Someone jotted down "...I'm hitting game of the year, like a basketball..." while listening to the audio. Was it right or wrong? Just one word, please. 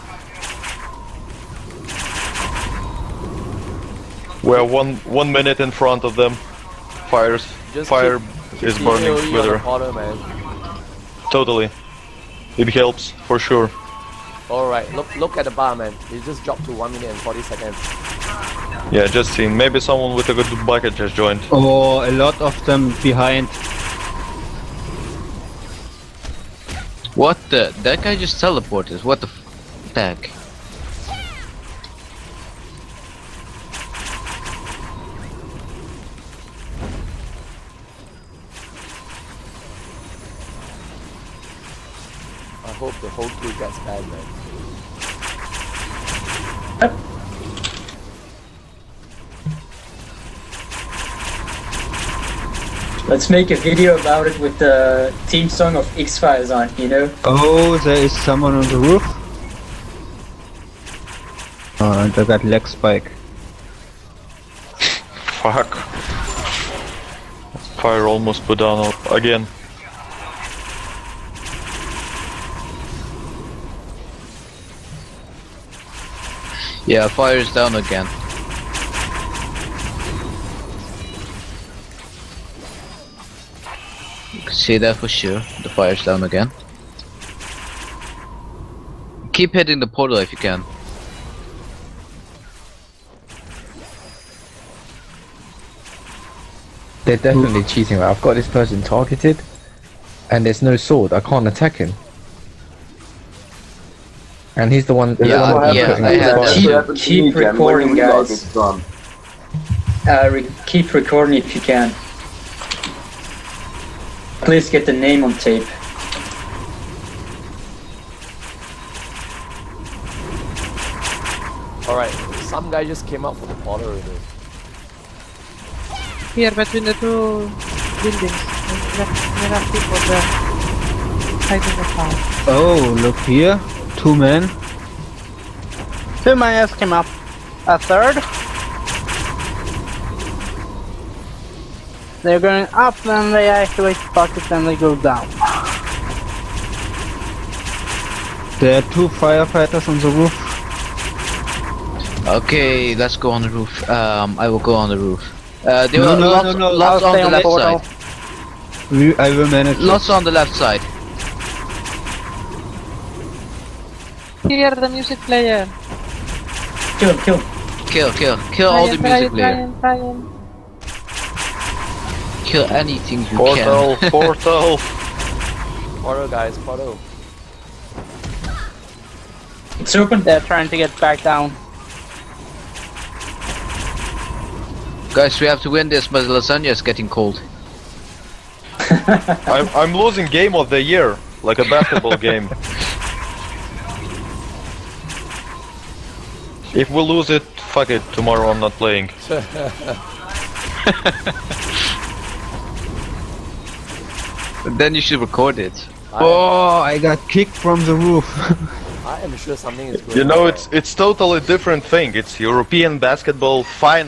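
wrong.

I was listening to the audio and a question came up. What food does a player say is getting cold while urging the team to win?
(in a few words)
lasagna.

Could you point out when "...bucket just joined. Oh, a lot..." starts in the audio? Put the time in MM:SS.
00:20.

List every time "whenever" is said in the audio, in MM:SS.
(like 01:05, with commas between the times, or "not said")
not said.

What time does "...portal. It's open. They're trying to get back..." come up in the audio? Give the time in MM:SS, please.
02:56.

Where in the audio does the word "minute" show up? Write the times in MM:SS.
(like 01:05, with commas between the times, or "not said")
00:05, 00:16.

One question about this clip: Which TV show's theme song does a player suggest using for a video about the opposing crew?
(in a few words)
X-Files.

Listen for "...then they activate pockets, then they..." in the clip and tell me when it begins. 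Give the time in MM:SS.
02:23.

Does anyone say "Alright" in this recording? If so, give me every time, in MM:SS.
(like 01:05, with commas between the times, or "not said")
00:14, 02:01.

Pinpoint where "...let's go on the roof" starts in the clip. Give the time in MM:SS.
02:32.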